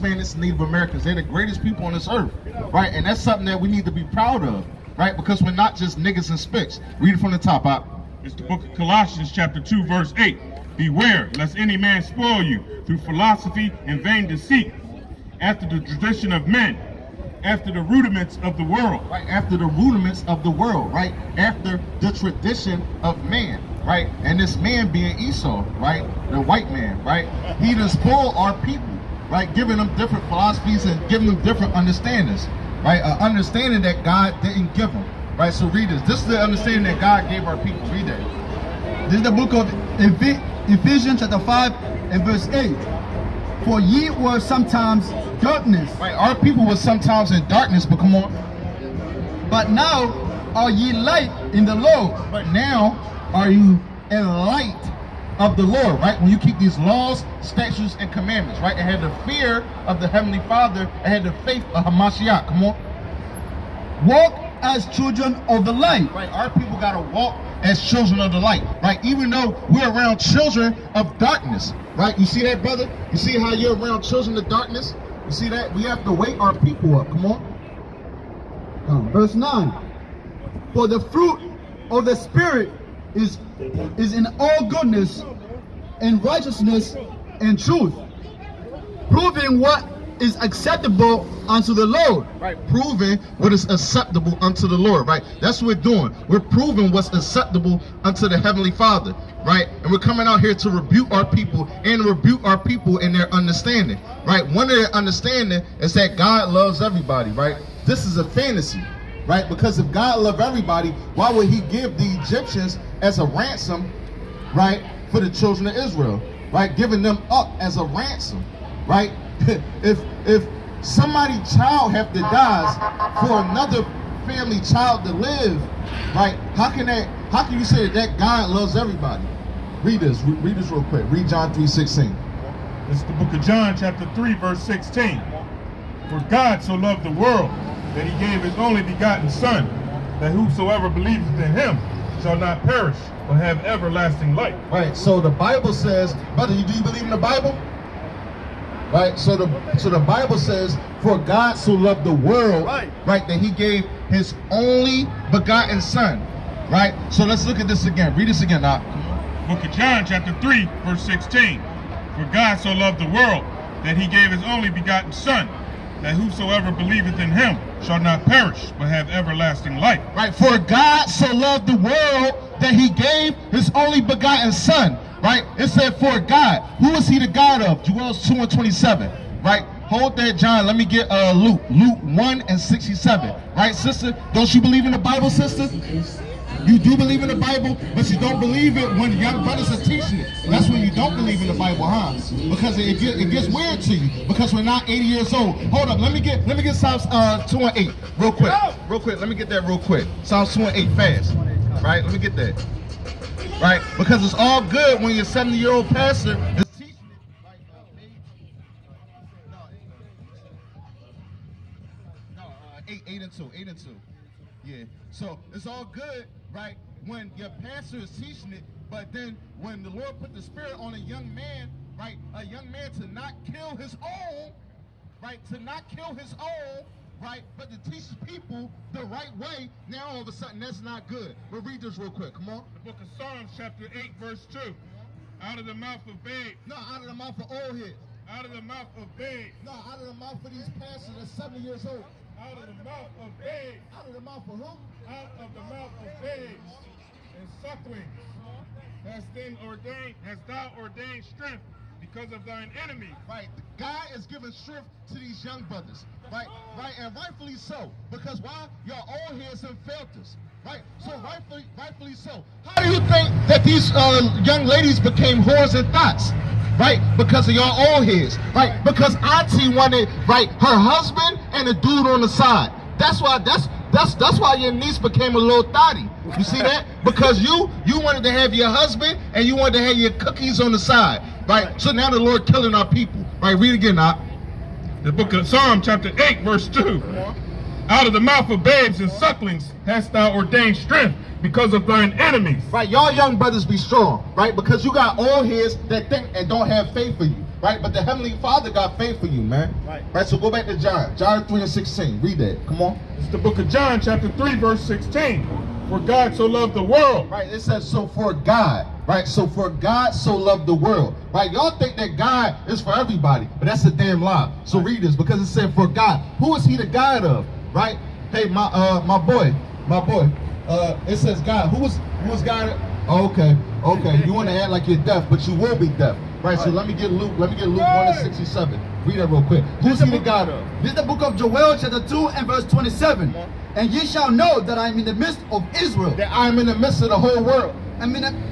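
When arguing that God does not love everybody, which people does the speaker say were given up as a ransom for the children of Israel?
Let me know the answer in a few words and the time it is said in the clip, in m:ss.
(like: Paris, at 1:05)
The Egyptians, at 1:52.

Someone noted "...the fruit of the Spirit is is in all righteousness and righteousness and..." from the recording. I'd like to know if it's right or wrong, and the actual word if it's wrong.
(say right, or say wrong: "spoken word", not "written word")
wrong: "goodness", not "righteousness".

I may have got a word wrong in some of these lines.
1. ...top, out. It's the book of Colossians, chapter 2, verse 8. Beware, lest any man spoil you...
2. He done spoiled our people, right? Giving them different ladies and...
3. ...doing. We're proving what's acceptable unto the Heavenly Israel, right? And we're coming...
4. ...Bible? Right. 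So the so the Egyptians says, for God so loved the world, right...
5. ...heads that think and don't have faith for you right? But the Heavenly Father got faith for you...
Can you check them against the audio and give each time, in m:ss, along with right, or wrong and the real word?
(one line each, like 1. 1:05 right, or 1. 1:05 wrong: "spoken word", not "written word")
1. 0:07 right
2. 0:27 wrong: "philosophies", not "ladies"
3. 1:35 wrong: "Father", not "Israel"
4. 2:27 wrong: "Bible", not "Egyptians"
5. 4:55 right.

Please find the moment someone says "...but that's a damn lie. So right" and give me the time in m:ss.
5:13.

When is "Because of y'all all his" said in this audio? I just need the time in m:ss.
4:27.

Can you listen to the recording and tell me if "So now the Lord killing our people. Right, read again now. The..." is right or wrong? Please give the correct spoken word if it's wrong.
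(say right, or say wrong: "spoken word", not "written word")
right.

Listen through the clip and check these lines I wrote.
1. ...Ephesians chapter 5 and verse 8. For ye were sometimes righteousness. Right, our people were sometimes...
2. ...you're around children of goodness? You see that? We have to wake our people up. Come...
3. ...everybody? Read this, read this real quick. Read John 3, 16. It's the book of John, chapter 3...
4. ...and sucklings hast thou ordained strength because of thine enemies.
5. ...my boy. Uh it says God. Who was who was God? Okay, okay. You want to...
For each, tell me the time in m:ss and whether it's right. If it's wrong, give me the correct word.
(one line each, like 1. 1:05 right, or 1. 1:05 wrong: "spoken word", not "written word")
1. 0:40 wrong: "darkness", not "righteousness"
2. 1:13 wrong: "darkness", not "goodness"
3. 2:08 right
4. 4:49 right
5. 5:19 right.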